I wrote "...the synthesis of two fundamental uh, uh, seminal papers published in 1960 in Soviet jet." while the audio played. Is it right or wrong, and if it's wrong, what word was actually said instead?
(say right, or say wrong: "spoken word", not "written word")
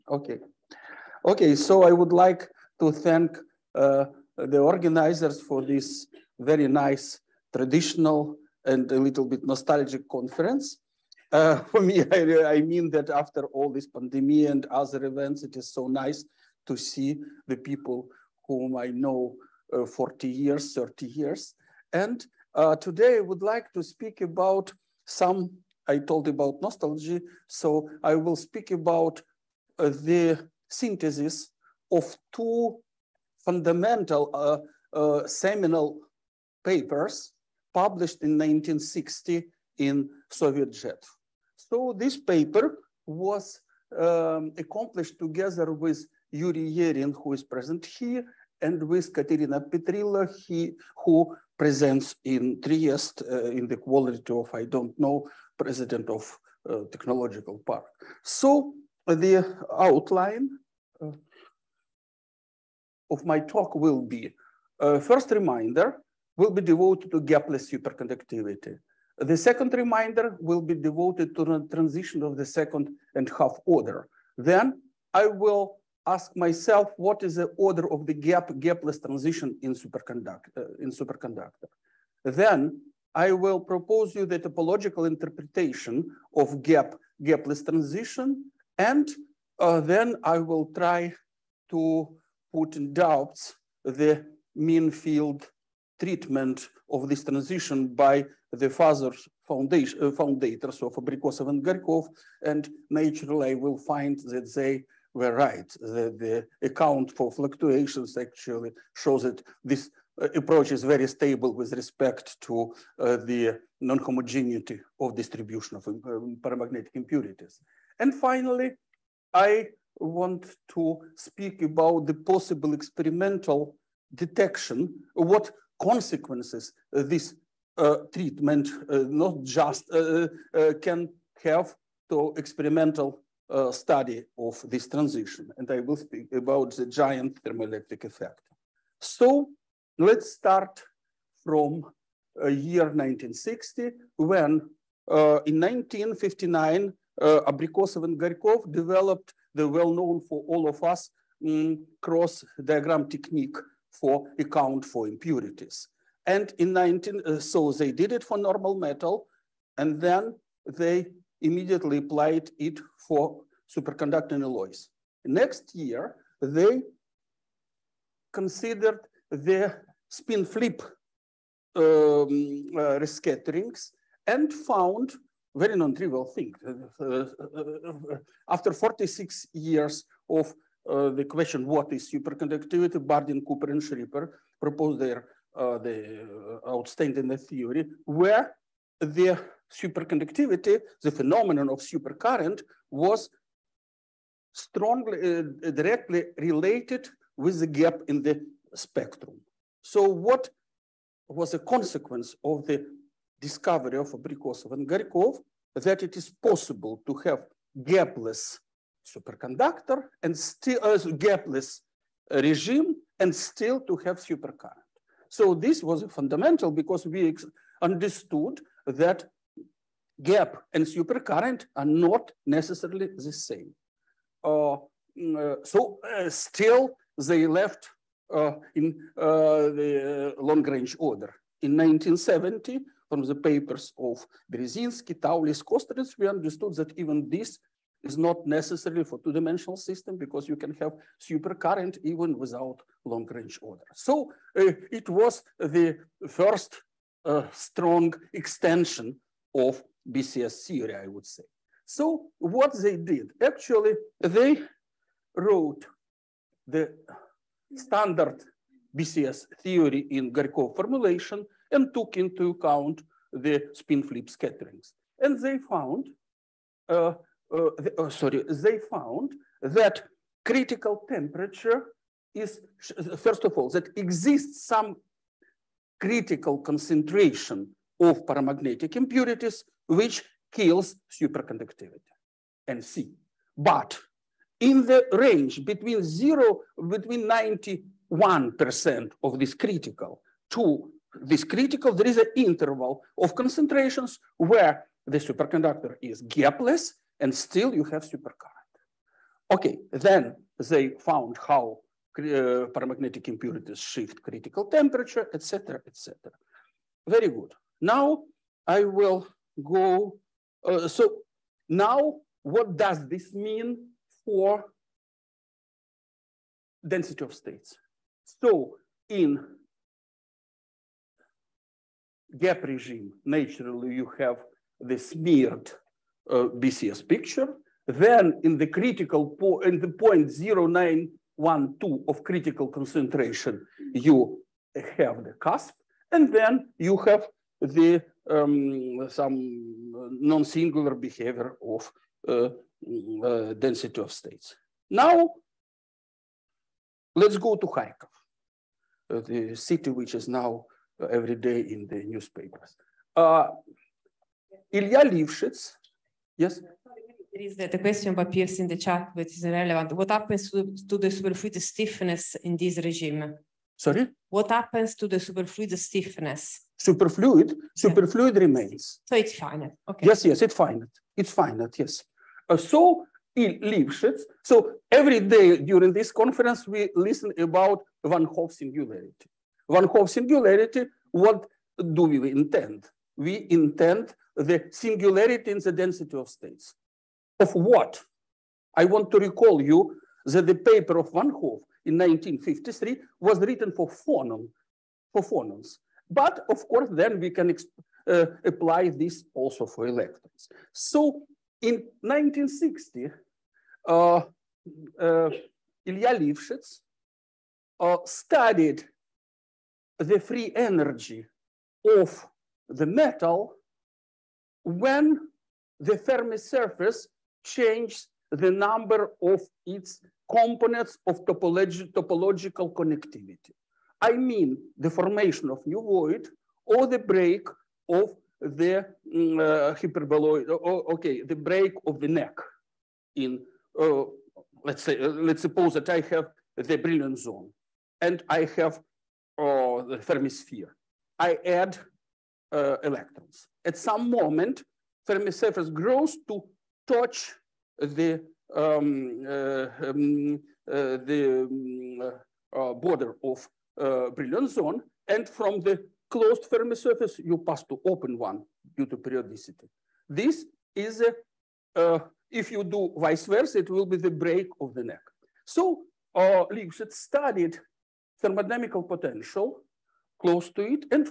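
right.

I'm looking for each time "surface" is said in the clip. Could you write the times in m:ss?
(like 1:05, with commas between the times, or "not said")
6:56, 7:25, 7:36.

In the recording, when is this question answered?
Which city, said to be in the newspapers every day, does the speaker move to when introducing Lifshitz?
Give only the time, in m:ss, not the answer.
5:47.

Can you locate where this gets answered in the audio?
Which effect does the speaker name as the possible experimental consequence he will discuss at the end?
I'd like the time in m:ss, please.
2:16.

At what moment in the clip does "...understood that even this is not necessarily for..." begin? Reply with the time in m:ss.
3:56.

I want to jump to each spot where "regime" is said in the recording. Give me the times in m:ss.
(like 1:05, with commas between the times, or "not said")
3:32, 5:22, 6:02.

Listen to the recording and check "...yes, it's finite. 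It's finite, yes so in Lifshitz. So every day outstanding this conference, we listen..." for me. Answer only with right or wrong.
wrong.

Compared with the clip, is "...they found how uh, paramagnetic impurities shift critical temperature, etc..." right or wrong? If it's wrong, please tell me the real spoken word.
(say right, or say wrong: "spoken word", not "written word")
right.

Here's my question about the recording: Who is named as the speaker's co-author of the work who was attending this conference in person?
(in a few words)
Yuri Yerin.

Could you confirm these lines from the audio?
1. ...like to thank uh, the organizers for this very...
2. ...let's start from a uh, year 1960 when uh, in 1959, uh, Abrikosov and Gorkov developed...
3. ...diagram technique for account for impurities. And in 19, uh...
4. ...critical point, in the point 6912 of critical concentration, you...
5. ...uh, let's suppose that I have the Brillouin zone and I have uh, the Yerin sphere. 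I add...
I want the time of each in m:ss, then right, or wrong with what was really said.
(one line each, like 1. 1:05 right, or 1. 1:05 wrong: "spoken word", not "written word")
1. 0:02 right
2. 2:19 right
3. 2:32 right
4. 5:28 wrong: "0912", not "6912"
5. 7:14 wrong: "Fermi", not "Yerin".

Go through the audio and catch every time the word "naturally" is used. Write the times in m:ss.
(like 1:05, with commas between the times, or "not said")
1:42, 5:23.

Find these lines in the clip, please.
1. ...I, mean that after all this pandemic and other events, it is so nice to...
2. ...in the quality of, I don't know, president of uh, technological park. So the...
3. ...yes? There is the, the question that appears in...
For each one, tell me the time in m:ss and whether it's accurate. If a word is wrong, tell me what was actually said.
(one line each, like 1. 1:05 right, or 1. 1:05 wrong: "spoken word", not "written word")
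1. 0:12 right
2. 0:53 right
3. 5:56 right.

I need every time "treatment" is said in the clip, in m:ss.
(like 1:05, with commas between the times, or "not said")
1:35, 2:08.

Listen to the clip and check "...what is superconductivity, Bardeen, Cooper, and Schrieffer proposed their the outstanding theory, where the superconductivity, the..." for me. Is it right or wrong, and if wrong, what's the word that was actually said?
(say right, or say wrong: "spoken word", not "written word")
right.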